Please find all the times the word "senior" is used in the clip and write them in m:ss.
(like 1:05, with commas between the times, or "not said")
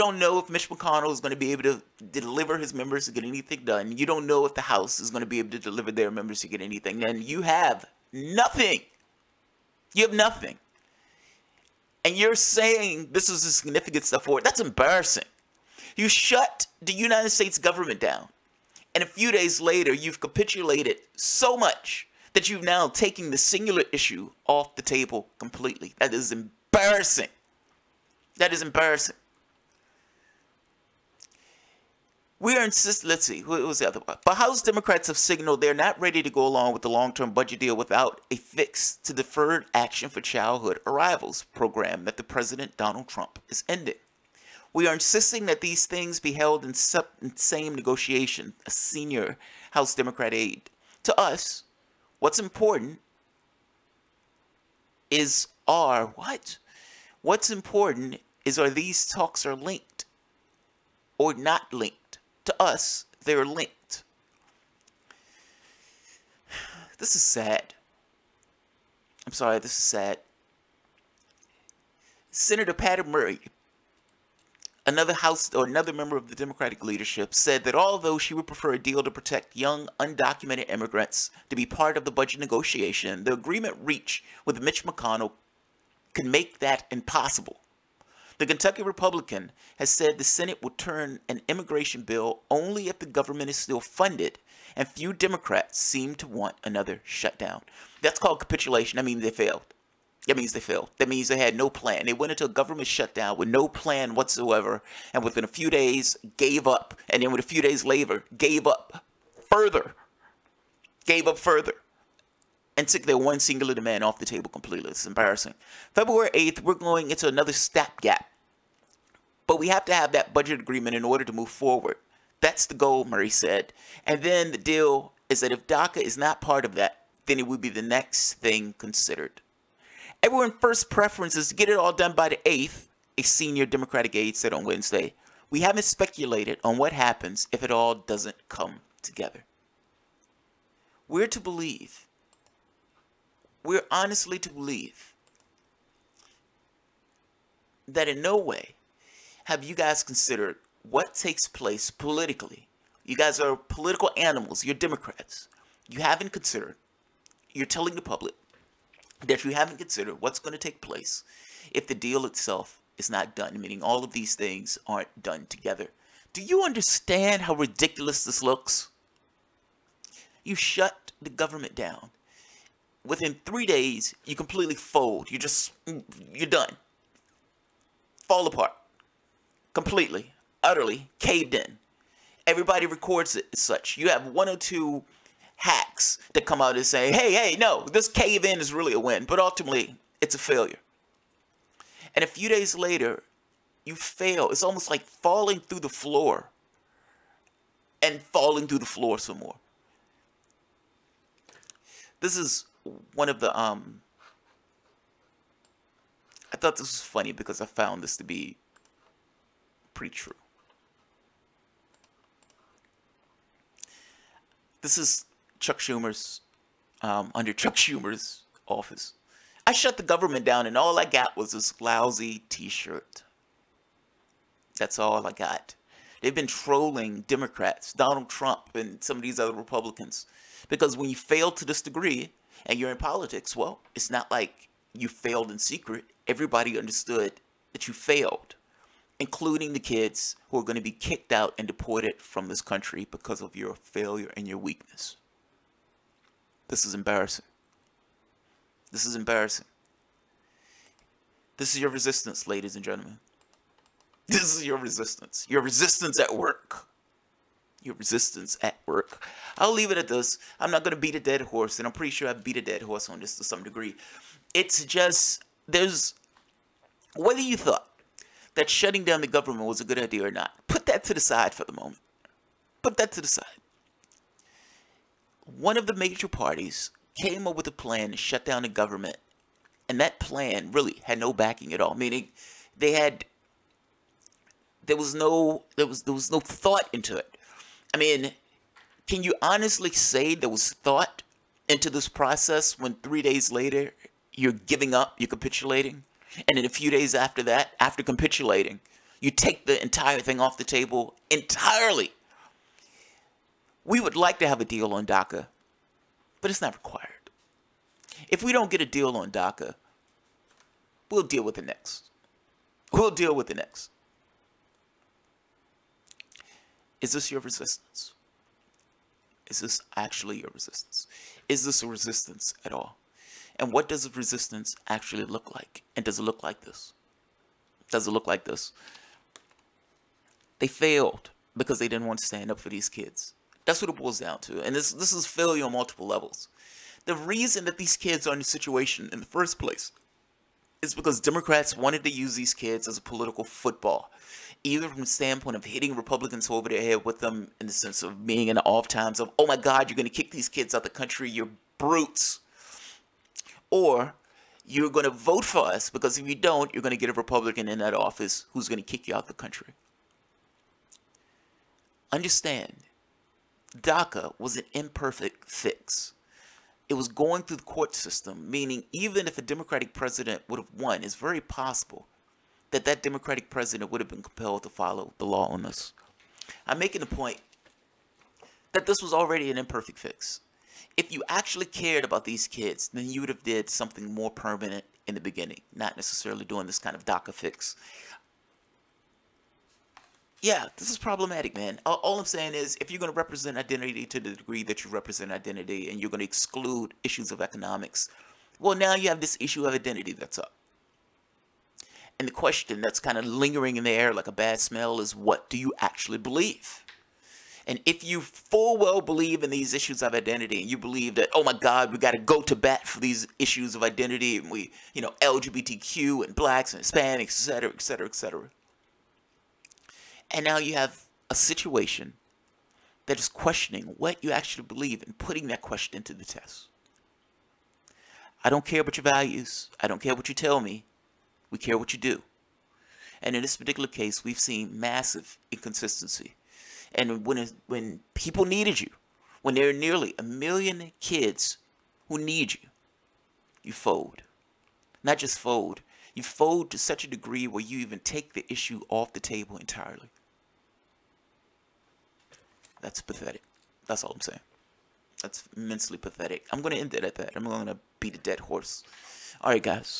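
0:48, 2:13.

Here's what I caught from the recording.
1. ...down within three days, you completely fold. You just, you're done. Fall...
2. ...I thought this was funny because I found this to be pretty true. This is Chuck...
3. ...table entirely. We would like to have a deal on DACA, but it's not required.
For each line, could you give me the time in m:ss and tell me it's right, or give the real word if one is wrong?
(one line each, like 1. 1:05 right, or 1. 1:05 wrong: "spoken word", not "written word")
1. 2:51 right
2. 3:26 right
3. 5:00 right.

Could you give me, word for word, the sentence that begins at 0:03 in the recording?
You don't know if the House is going to be able to deliver their members to get anything And You have nothing.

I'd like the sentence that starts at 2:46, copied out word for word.
Do you understand how ridiculous this looks?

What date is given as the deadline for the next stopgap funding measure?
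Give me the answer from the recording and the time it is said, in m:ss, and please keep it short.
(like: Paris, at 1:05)
February 8th, at 1:55.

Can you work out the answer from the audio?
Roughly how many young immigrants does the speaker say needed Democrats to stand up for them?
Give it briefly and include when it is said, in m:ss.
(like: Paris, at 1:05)
Nearly a million, at 7:19.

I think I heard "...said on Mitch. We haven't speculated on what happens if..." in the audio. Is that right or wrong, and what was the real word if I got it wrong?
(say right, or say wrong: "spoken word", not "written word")
wrong: "Wednesday", not "Mitch".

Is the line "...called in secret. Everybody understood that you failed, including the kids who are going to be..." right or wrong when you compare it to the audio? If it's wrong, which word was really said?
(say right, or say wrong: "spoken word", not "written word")
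wrong: "failed", not "called".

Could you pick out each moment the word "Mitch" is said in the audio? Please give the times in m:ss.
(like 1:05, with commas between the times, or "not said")
0:00, 1:24.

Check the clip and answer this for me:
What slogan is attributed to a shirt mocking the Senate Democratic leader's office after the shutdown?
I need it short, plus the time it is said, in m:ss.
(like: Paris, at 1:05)
This lousy t-shirt, at 3:41.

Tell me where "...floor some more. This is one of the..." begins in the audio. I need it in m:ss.
3:18.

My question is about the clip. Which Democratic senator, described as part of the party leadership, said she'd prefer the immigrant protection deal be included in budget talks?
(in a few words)
Patty Murray.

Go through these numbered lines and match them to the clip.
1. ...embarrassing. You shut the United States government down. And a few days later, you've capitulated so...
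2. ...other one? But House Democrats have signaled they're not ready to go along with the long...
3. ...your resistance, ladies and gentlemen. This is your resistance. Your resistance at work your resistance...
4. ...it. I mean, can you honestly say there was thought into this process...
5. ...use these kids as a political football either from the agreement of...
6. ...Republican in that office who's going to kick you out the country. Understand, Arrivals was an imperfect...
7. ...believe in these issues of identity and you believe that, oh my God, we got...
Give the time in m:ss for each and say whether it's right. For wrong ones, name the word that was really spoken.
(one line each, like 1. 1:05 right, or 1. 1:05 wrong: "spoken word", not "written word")
1. 0:14 right
2. 0:33 right
3. 4:11 right
4. 4:47 right
5. 5:42 wrong: "standpoint", not "agreement"
6. 5:57 wrong: "DACA", not "Arrivals"
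7. 6:49 right.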